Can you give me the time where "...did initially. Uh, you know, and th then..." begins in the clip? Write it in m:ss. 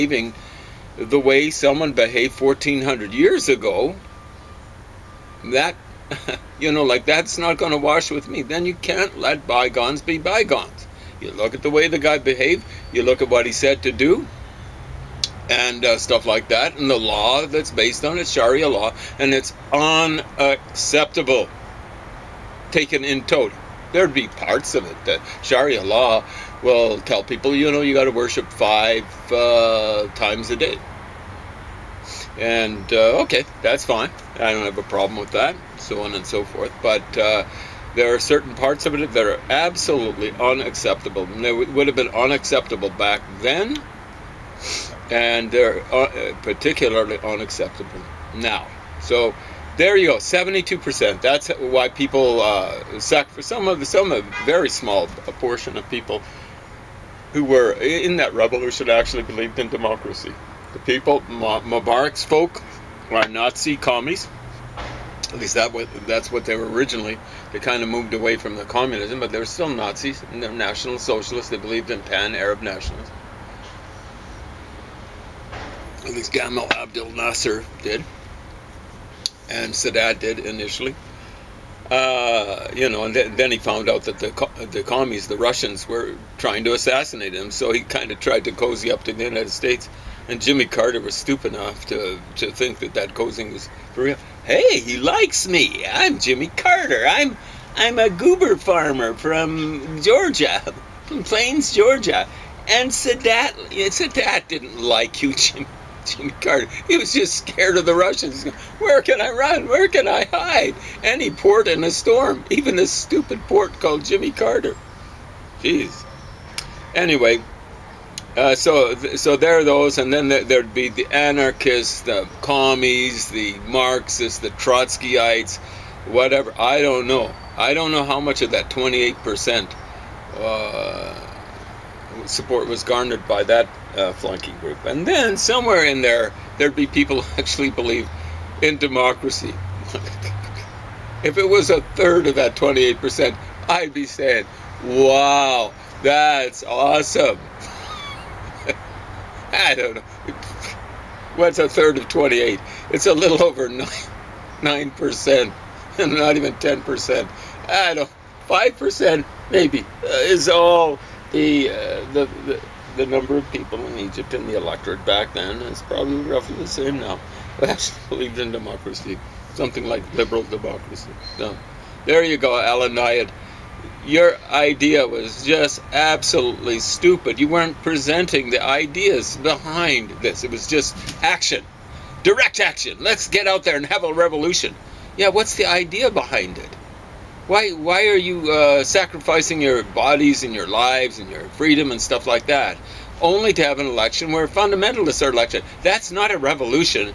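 1:20.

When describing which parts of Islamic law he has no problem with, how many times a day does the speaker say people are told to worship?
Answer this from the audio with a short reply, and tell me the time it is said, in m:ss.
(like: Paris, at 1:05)
5, at 0:28.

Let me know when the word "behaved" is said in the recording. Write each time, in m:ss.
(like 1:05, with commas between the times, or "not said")
0:01, 0:12.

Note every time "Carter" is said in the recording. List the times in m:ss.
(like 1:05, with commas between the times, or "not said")
1:30, 1:36, 1:46, 1:54.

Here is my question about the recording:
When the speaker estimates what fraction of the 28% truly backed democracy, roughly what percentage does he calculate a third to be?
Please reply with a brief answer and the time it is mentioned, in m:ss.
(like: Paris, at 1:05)
a little over 9, at 2:33.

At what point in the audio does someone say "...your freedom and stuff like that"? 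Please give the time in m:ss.
3:11.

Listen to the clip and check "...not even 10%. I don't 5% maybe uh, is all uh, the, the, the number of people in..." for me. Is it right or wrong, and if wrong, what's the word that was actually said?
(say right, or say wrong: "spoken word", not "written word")
right.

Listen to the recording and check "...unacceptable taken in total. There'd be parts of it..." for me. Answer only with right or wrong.
right.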